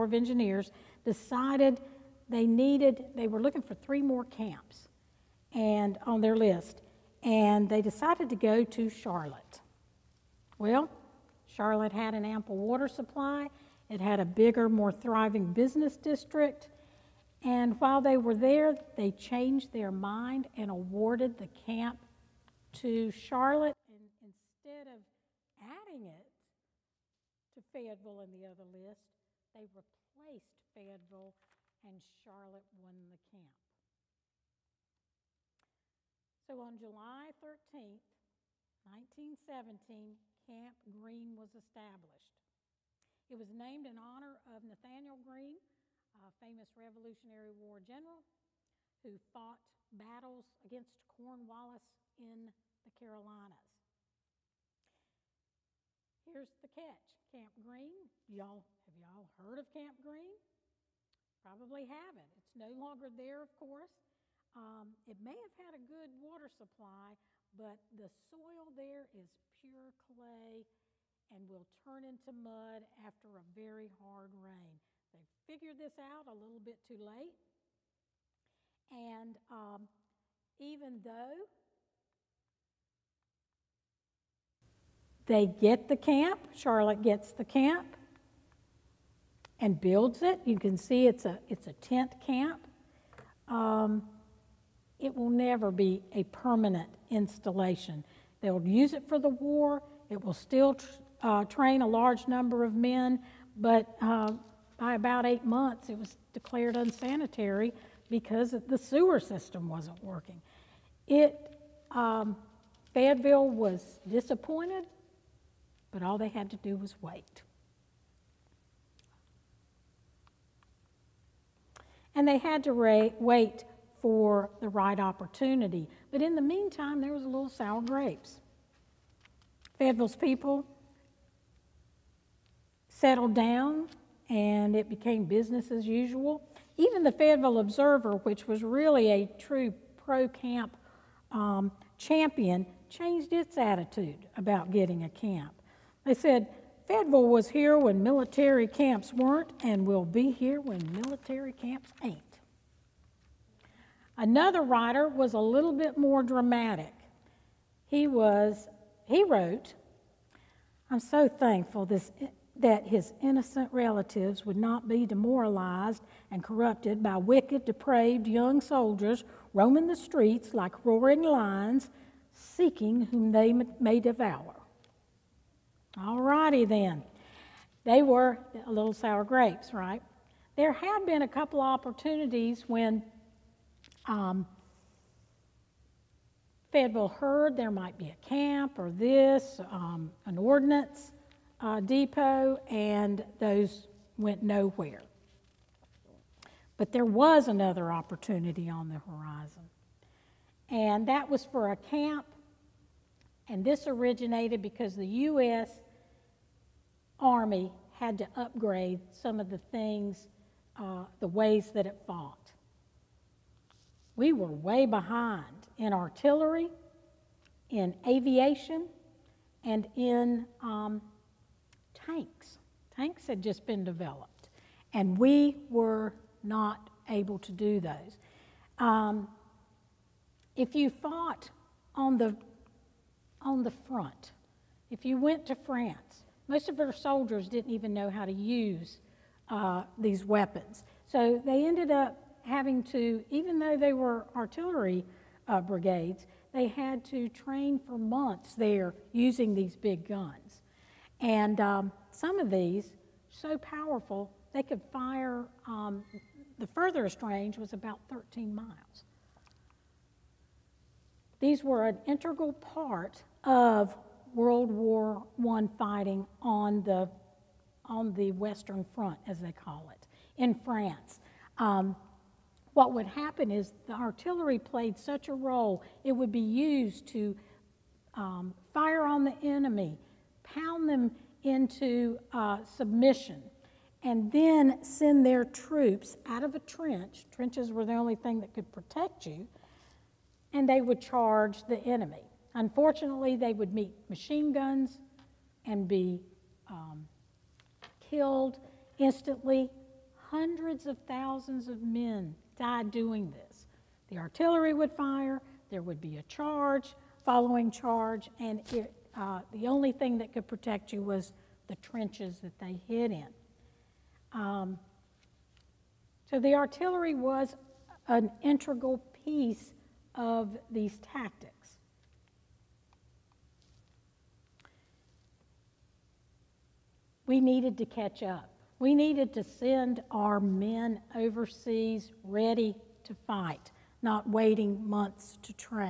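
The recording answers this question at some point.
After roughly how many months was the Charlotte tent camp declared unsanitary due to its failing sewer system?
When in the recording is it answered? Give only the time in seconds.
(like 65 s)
105 s.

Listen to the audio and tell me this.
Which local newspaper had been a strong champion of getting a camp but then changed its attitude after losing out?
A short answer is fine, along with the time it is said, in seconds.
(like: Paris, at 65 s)
Fayetteville Observer, at 137 s.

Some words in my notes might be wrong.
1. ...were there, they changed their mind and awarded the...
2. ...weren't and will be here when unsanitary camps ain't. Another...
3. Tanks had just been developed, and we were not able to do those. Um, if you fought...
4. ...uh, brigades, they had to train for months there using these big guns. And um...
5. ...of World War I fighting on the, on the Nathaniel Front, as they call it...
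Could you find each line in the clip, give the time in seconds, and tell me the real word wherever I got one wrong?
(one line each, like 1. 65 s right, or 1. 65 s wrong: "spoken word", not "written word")
1. 18 s right
2. 149 s wrong: "military", not "unsanitary"
3. 222 s right
4. 245 s right
5. 263 s wrong: "Western", not "Nathaniel".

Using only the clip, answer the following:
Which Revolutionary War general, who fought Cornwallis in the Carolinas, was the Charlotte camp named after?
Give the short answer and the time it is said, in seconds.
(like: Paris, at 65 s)
Nathaniel Greene, at 44 s.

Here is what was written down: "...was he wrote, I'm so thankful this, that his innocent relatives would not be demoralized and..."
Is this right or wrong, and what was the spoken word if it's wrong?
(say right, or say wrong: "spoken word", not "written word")
right.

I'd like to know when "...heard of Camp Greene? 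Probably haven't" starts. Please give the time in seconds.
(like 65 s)
59 s.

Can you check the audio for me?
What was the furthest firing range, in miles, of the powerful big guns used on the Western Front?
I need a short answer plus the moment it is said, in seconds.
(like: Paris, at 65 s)
13 miles, at 258 s.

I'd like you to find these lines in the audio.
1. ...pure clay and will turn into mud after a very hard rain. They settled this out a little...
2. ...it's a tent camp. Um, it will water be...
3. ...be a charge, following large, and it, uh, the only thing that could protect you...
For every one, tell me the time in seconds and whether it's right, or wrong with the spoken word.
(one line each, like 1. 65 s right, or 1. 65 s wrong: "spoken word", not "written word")
1. 69 s wrong: "figured", not "settled"
2. 91 s wrong: "never", not "water"
3. 306 s wrong: "charge", not "large".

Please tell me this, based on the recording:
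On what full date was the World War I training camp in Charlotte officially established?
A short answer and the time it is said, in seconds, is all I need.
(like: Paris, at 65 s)
July 13, 1917, at 36 s.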